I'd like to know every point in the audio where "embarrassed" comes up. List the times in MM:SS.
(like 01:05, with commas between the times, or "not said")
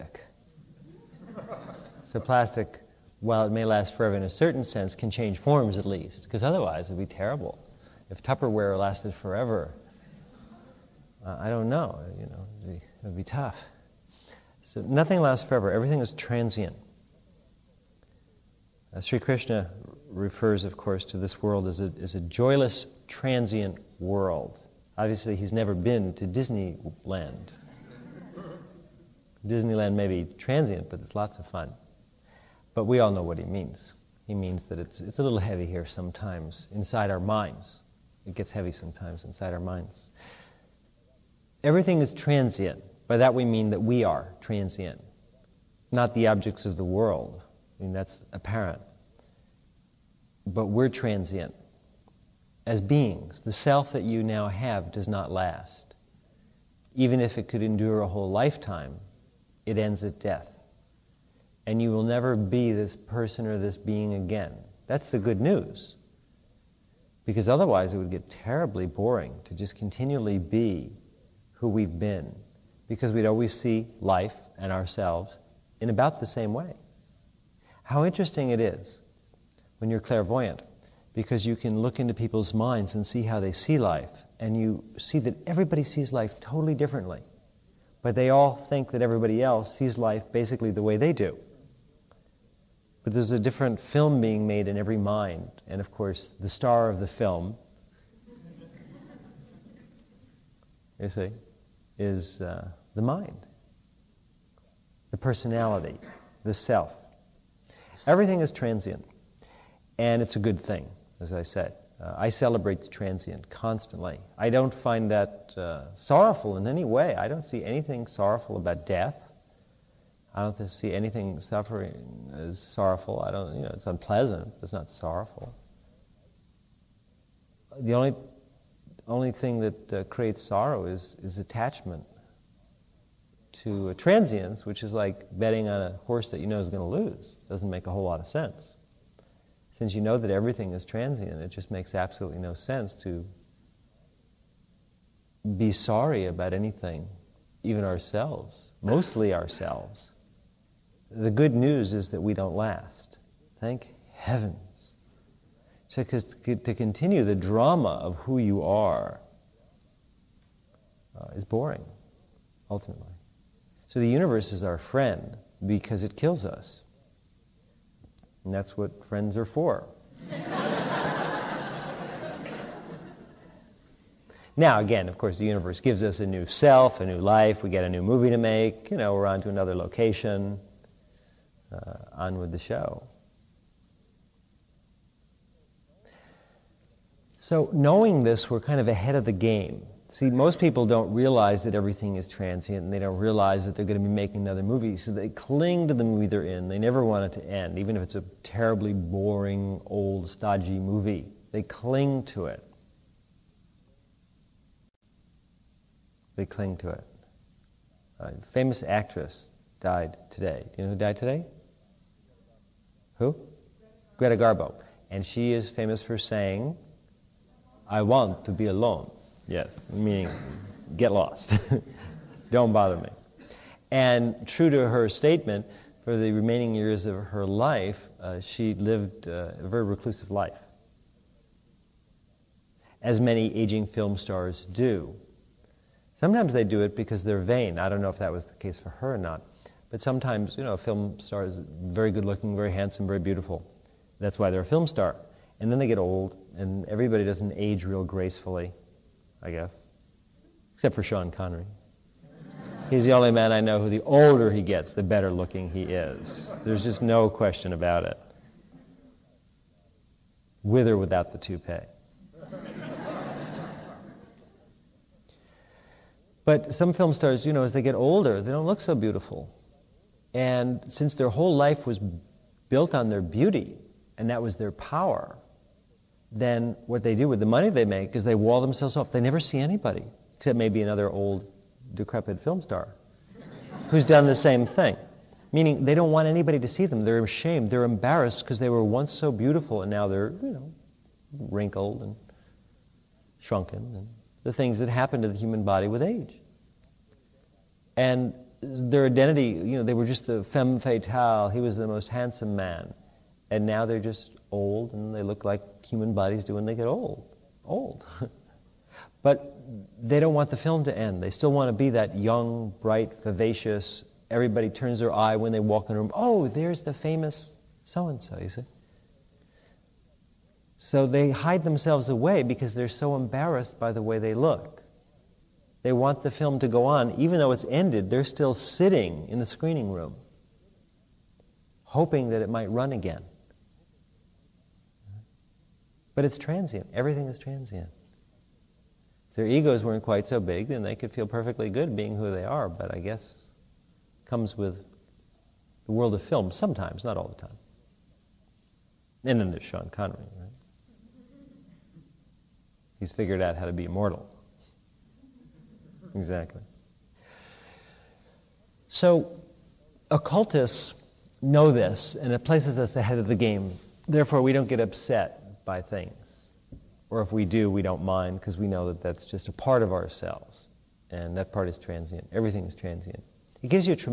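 04:47, 05:23.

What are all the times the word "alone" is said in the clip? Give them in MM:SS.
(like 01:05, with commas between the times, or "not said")
03:38.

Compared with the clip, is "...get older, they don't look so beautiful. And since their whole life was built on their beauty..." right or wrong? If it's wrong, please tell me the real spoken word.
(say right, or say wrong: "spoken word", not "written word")
right.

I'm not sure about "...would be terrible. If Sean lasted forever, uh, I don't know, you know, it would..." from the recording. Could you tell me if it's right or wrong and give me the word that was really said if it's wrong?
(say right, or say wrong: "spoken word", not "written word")
wrong: "Tupperware", not "Sean".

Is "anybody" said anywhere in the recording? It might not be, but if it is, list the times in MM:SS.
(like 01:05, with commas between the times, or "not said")
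04:39, 04:46.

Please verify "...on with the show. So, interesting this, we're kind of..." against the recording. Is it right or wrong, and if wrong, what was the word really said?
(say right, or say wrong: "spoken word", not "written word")
wrong: "knowing", not "interesting".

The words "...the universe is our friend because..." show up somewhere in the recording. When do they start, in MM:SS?
02:43.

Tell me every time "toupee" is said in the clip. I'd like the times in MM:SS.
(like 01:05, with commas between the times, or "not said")
04:21.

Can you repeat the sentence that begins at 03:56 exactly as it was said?
Sometimes they do it because they're vain.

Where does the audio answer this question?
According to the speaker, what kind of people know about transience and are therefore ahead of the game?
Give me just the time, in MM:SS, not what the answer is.
06:00.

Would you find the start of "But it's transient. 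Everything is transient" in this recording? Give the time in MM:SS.
05:36.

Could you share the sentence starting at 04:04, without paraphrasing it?
That's why they're a film star.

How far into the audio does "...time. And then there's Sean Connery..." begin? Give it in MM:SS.
05:47.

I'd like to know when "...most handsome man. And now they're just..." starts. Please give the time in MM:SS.
05:01.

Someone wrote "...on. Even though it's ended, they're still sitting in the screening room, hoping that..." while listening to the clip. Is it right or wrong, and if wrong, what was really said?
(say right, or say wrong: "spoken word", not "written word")
right.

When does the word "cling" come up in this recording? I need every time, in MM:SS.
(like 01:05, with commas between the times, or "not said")
03:15, 03:21, 03:26.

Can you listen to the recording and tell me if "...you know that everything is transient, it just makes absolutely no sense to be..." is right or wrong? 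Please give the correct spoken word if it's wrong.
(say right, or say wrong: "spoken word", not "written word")
right.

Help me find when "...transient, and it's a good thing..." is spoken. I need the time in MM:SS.
01:48.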